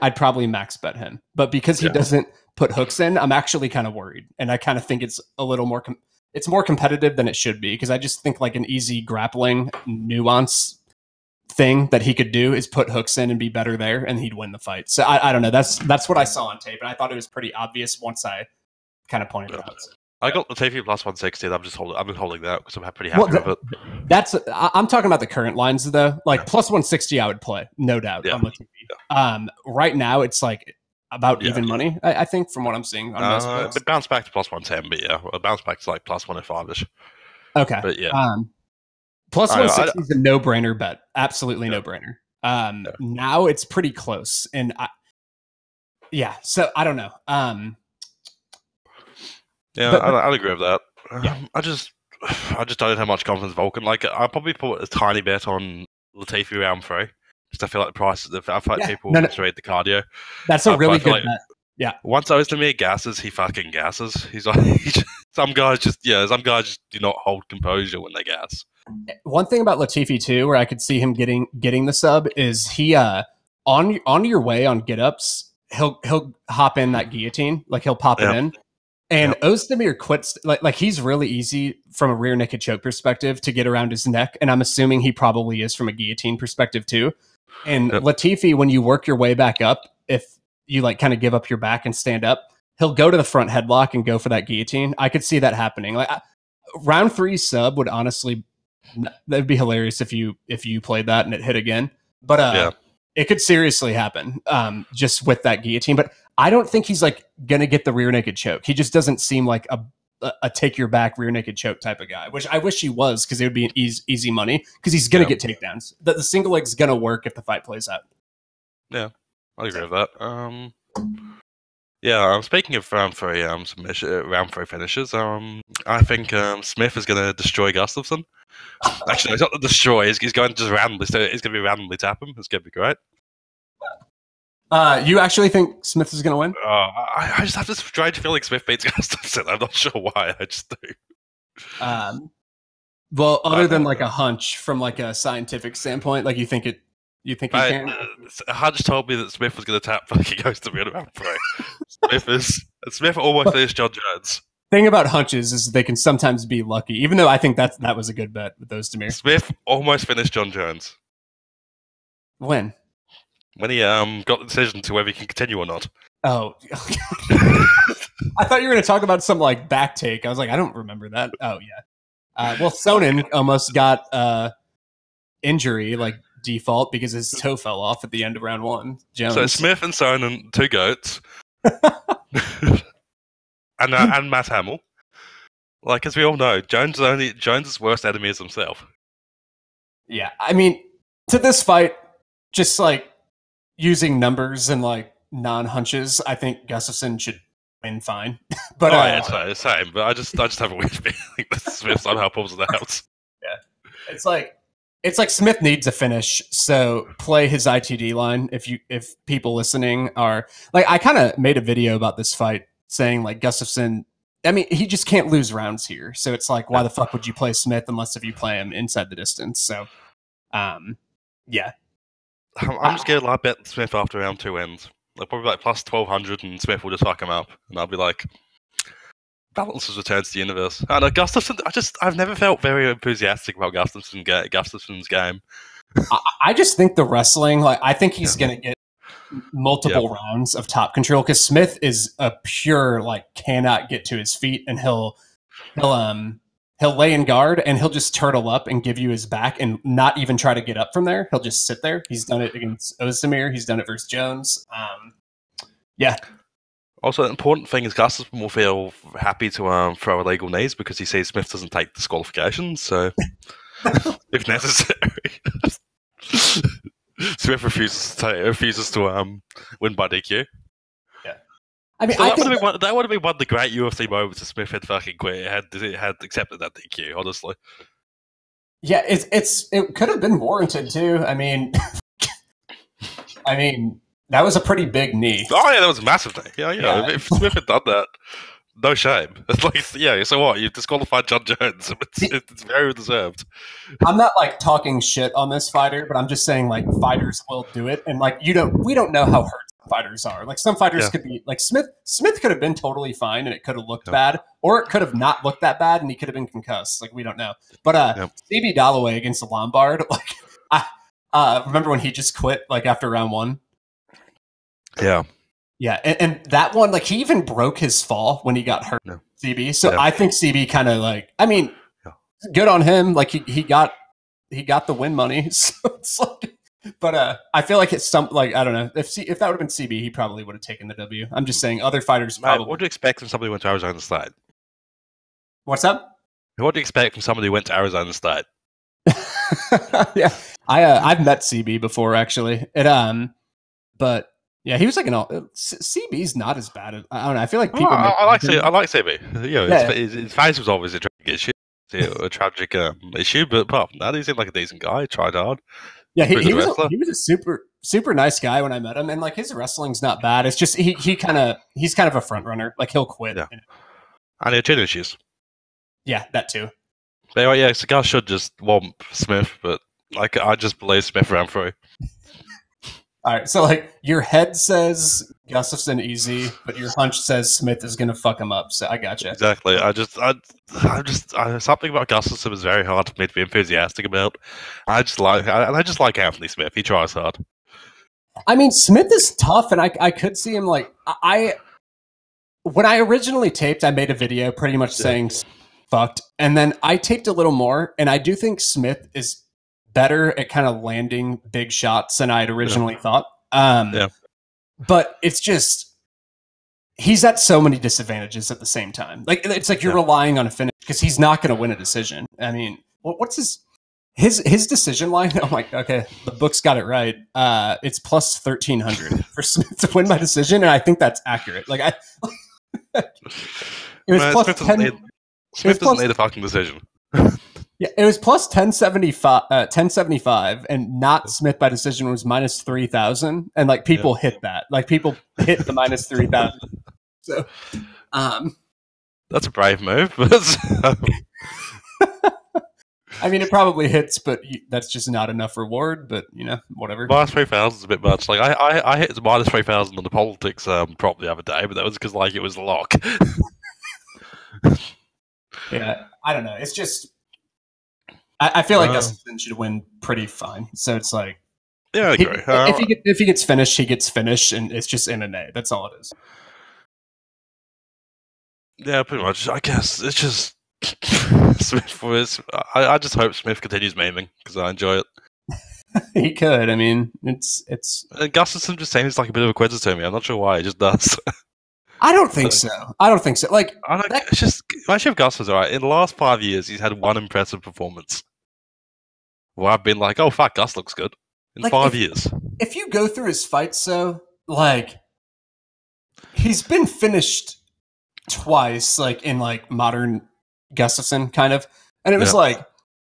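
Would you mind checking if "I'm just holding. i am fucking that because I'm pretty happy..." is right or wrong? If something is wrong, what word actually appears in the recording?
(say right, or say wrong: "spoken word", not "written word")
wrong: "holding", not "fucking".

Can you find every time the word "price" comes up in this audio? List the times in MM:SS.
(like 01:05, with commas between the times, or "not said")
00:57.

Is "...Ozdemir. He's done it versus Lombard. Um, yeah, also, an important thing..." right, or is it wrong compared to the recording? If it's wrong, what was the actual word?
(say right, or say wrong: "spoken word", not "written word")
wrong: "Jones", not "Lombard".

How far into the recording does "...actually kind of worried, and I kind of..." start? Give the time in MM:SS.
00:03.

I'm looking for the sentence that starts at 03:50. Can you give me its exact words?
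I ah, know I just I've never felt very enthusiastic about Gustafsson, Gustafsson's game.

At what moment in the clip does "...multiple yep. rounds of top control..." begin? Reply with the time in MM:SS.
03:59.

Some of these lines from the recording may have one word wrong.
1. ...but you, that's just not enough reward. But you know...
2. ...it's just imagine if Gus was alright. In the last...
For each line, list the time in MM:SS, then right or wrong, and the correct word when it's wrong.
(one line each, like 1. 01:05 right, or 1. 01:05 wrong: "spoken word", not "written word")
1. 07:24 right
2. 08:04 right.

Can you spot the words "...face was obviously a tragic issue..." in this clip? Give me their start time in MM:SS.
05:50.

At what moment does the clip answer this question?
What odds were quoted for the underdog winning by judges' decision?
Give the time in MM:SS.
06:57.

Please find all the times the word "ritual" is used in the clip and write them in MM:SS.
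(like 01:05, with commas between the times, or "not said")
not said.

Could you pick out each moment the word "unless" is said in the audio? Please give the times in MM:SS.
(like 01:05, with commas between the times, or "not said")
03:37.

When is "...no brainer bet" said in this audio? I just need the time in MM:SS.
00:40.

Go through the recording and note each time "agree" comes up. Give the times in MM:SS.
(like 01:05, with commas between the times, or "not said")
00:50, 01:59.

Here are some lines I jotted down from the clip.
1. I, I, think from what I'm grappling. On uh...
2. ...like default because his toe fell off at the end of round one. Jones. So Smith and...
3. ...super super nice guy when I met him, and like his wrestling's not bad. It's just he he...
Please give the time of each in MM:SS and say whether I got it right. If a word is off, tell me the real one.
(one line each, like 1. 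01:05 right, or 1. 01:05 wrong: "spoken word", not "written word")
1. 00:32 wrong: "seeing", not "grappling"
2. 02:55 right
3. 05:57 right.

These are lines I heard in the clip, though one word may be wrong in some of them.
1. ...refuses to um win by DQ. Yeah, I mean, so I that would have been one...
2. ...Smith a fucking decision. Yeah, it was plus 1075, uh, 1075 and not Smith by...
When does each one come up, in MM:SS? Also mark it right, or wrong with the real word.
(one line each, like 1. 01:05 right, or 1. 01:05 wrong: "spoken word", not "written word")
1. 04:28 right
2. 07:05 right.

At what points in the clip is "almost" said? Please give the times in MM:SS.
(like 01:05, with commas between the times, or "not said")
02:33, 02:39, 02:53.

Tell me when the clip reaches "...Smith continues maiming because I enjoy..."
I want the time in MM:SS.
07:53.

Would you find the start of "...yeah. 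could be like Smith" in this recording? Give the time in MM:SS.
05:01.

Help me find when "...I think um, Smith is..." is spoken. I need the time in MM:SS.
02:05.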